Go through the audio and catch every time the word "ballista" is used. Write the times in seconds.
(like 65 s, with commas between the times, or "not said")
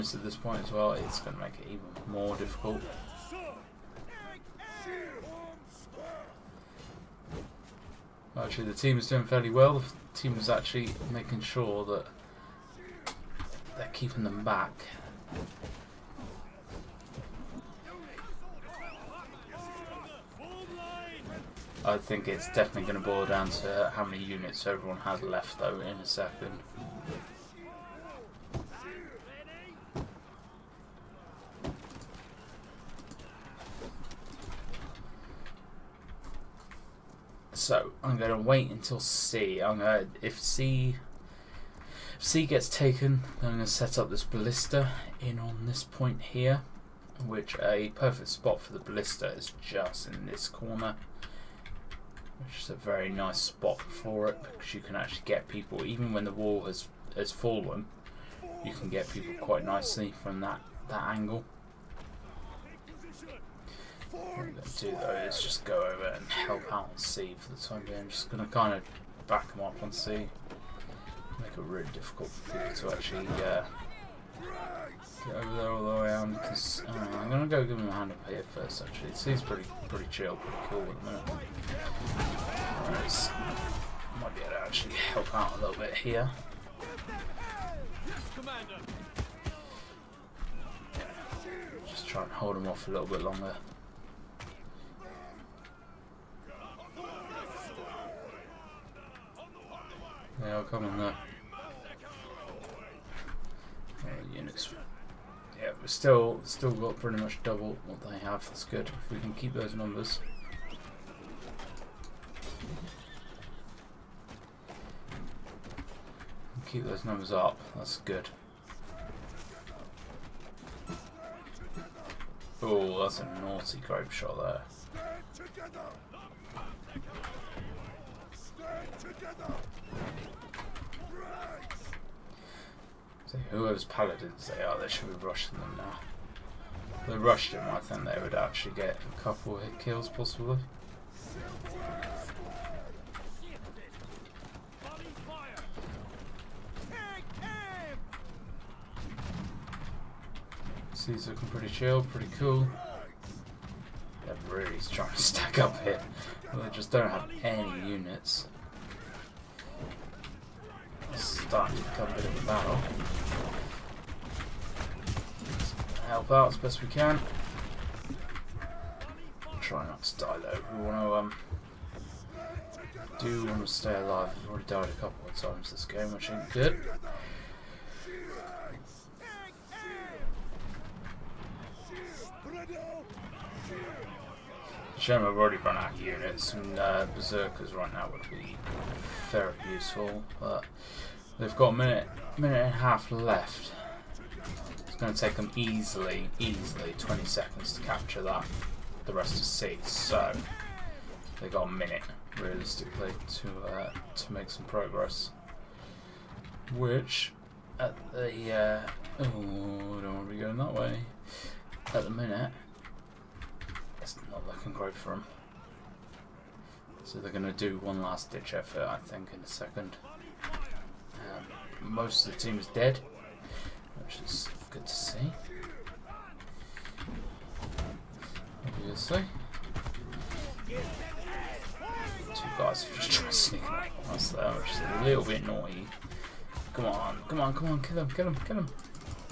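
44 s, 48 s.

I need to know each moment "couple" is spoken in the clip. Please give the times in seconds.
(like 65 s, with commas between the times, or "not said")
139 s, 175 s.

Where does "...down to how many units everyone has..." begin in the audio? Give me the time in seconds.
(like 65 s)
23 s.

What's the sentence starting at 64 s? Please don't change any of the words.
What I'm going to do though is just go over and help out and see.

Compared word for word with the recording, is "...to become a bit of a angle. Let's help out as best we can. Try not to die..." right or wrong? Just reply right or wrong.
wrong.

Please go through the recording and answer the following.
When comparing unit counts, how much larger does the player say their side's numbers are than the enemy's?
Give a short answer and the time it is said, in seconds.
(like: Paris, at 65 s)
Double, at 107 s.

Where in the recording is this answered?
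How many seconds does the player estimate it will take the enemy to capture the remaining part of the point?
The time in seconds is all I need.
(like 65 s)
196 s.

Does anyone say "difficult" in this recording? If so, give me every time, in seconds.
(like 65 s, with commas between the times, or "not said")
2 s, 71 s.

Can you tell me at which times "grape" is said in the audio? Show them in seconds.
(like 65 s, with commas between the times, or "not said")
123 s.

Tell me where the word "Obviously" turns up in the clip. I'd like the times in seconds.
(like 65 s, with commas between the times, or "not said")
228 s.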